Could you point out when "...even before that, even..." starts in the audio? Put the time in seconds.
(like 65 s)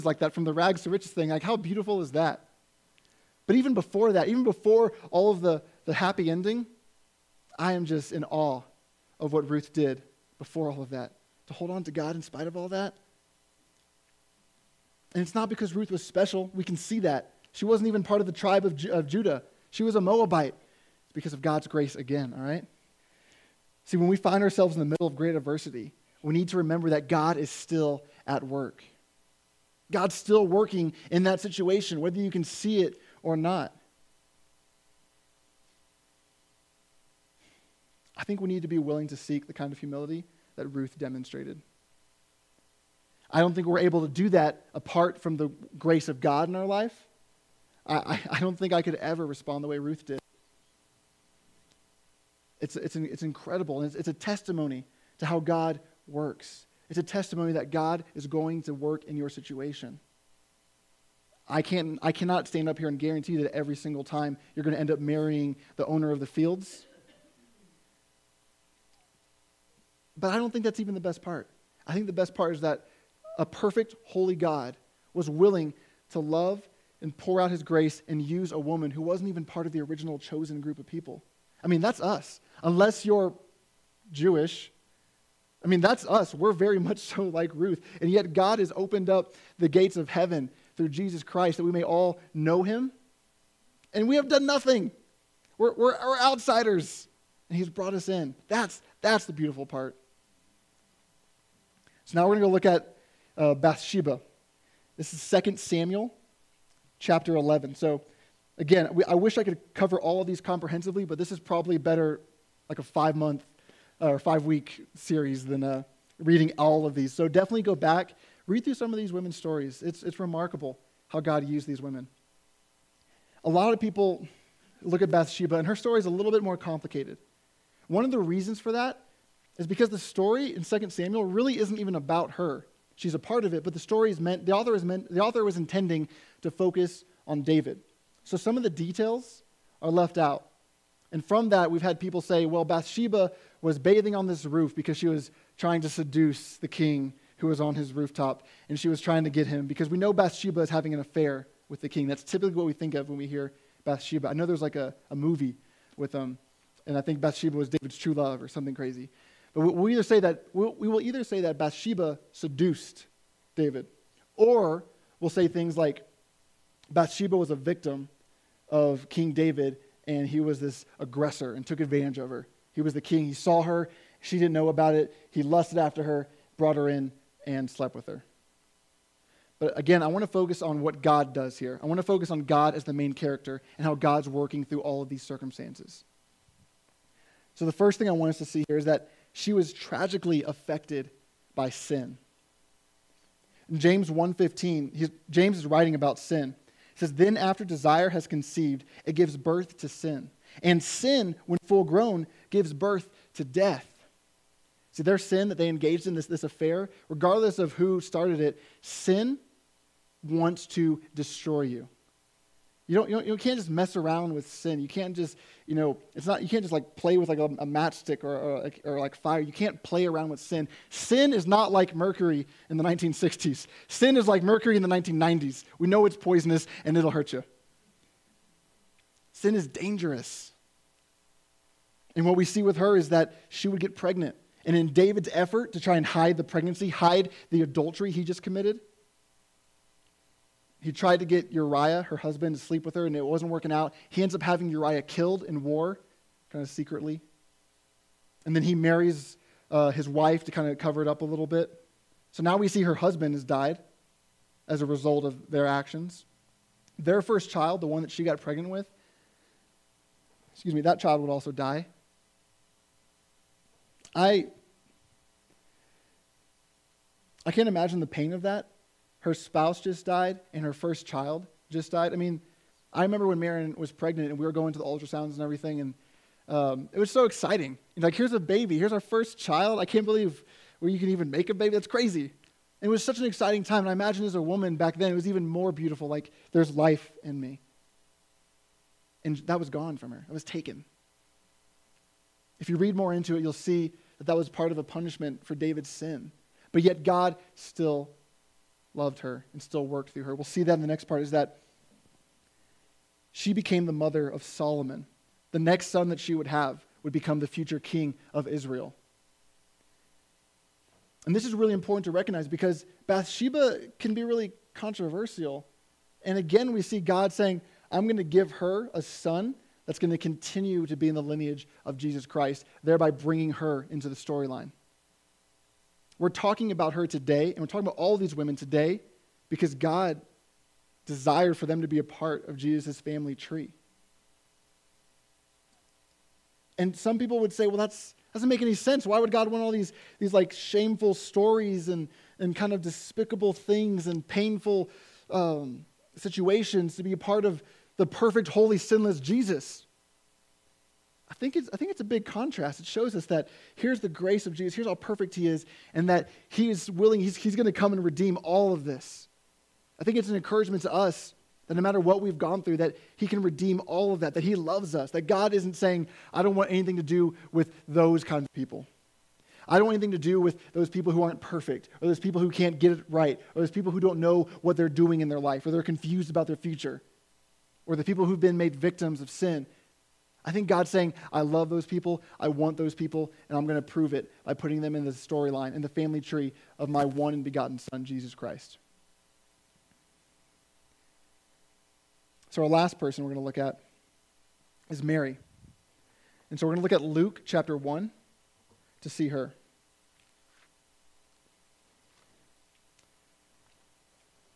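3 s.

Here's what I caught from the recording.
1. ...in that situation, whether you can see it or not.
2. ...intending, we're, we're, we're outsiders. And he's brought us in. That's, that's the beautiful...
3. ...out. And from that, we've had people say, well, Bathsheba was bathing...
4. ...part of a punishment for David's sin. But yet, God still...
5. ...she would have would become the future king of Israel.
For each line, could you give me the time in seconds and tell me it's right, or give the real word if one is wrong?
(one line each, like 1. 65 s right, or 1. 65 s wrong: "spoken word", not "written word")
1. 31 s right
2. 94 s wrong: "nothing", not "intending"
3. 140 s right
4. 294 s right
5. 306 s right.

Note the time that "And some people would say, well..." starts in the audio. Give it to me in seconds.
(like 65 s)
336 s.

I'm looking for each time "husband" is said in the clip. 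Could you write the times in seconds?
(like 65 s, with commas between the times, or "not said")
242 s, 252 s.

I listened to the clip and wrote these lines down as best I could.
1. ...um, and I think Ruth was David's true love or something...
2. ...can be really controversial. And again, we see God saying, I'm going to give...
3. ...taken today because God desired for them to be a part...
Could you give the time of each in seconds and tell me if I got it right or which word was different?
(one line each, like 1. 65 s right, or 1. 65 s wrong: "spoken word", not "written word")
1. 156 s wrong: "Bathsheba", not "Ruth"
2. 313 s right
3. 328 s wrong: "women", not "taken".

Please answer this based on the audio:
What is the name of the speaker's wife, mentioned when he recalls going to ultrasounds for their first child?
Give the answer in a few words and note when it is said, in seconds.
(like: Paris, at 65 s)
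Marion, at 273 s.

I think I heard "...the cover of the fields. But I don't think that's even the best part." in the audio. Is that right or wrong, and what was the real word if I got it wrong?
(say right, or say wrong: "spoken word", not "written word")
wrong: "owner", not "cover".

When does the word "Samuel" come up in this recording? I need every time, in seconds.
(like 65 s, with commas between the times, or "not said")
105 s, 130 s.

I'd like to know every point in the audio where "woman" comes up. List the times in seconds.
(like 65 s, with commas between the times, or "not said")
78 s, 284 s.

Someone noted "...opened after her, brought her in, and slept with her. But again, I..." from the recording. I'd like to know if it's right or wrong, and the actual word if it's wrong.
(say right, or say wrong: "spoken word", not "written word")
wrong: "lusted", not "opened".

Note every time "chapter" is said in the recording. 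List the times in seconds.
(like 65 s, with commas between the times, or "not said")
106 s, 397 s.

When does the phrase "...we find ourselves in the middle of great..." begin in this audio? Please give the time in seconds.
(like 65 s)
24 s.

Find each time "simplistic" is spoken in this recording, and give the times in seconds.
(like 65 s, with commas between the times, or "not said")
not said.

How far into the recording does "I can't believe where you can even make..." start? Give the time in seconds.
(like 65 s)
279 s.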